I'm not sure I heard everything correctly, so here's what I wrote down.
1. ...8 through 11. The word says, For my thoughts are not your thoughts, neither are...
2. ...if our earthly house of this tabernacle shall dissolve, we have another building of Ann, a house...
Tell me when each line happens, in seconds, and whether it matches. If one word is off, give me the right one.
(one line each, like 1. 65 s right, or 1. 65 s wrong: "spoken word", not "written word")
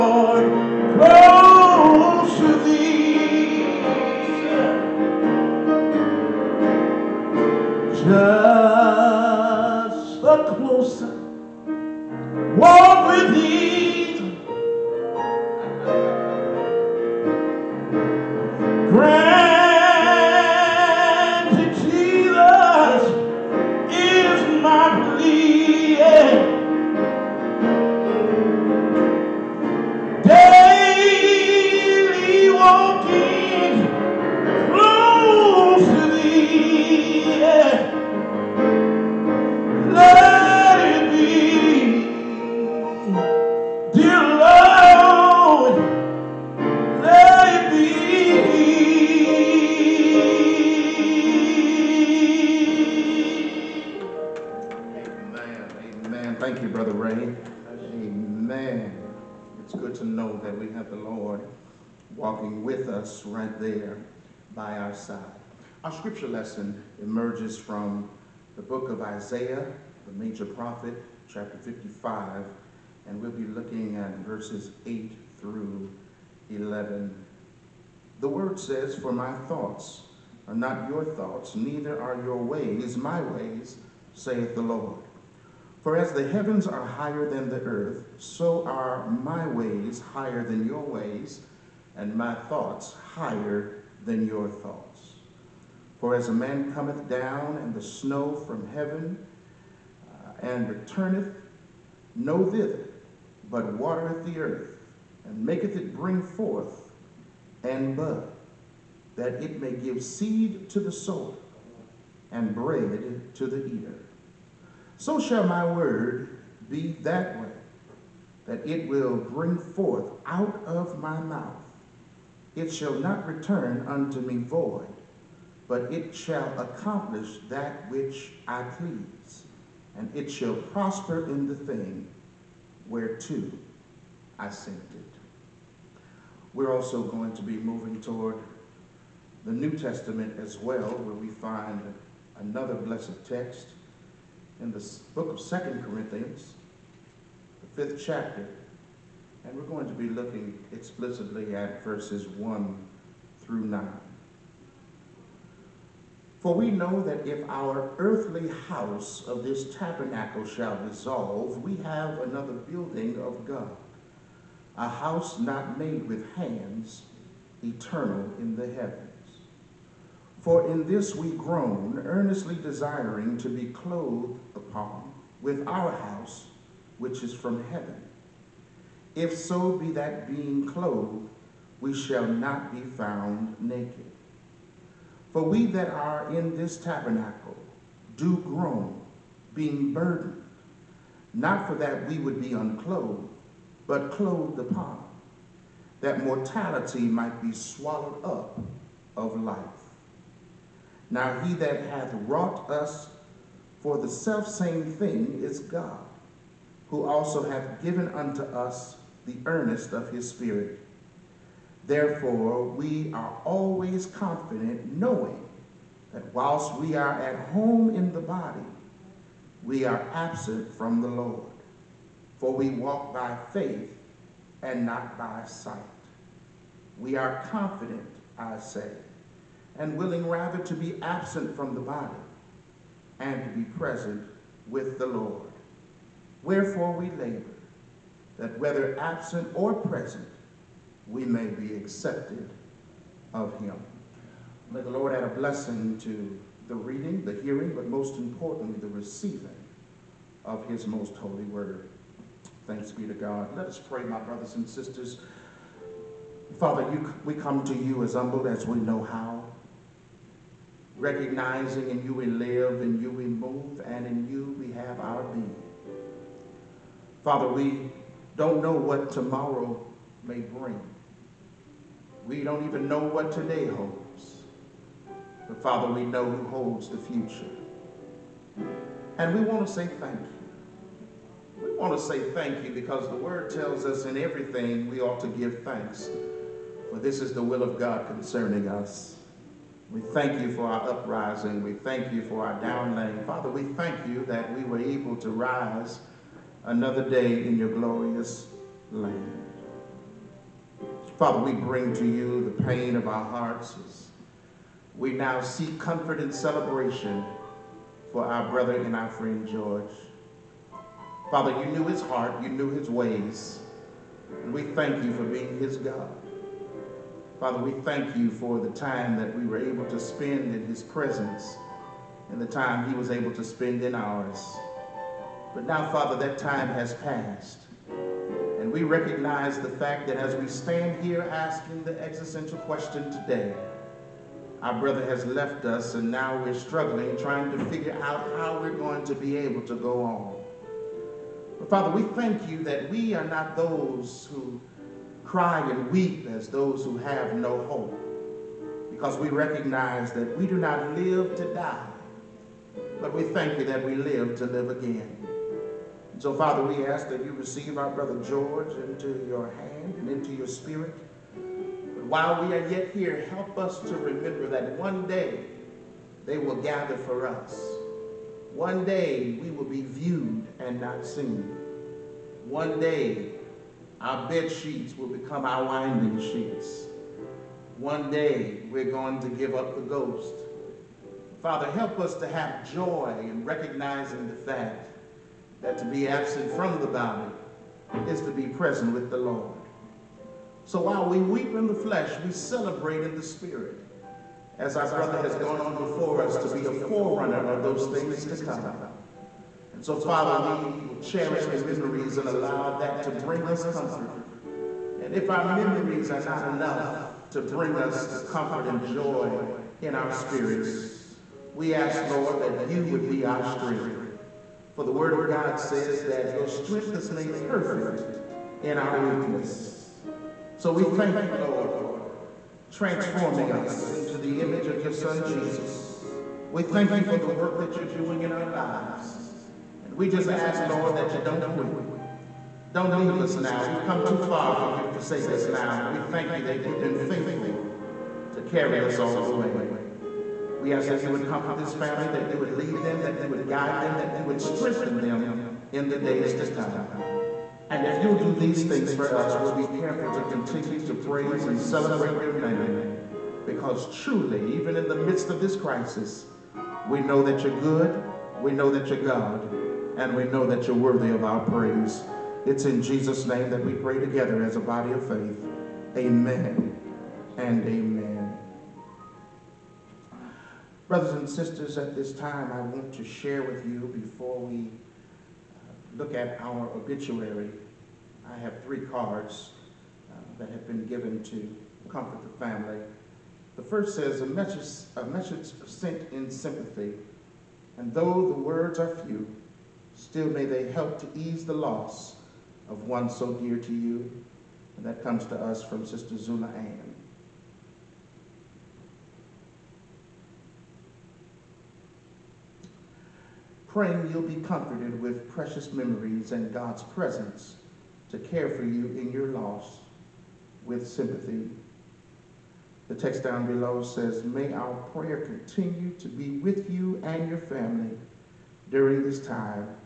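1. 74 s right
2. 157 s wrong: "God", not "Ann".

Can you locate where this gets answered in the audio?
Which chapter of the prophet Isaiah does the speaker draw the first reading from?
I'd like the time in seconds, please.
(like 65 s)
71 s.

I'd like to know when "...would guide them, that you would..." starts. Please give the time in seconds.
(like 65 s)
443 s.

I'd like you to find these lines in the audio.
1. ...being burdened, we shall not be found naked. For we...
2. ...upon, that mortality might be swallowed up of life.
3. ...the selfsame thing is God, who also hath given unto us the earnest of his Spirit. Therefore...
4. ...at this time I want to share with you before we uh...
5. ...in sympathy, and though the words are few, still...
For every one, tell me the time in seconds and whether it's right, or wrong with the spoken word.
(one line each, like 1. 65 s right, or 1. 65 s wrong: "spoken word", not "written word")
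1. 180 s wrong: "clothed", not "burdened"
2. 194 s right
3. 203 s right
4. 471 s right
5. 486 s right.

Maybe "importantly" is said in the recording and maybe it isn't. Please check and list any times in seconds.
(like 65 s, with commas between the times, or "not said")
248 s.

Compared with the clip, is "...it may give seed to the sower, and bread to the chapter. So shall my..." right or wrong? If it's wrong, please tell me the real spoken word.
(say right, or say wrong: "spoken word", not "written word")
wrong: "eater", not "chapter".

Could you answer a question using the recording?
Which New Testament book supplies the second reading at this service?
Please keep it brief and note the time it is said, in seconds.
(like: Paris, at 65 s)
Second Corinthians, at 145 s.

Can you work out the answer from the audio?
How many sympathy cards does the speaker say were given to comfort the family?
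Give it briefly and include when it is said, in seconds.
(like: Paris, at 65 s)
3, at 478 s.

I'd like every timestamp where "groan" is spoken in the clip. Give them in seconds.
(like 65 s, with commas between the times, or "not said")
171 s, 188 s.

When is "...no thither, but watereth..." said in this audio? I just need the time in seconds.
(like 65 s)
102 s.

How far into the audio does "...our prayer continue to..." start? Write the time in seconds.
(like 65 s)
514 s.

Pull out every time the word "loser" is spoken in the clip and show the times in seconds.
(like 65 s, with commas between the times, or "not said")
not said.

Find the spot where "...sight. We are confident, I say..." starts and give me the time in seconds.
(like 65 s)
225 s.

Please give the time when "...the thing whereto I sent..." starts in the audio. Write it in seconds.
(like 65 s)
131 s.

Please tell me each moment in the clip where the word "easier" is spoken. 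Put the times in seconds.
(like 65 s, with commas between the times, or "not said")
not said.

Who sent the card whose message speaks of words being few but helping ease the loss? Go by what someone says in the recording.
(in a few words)
Sister Zula Ann.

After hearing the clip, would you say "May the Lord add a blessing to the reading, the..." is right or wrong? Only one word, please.
right.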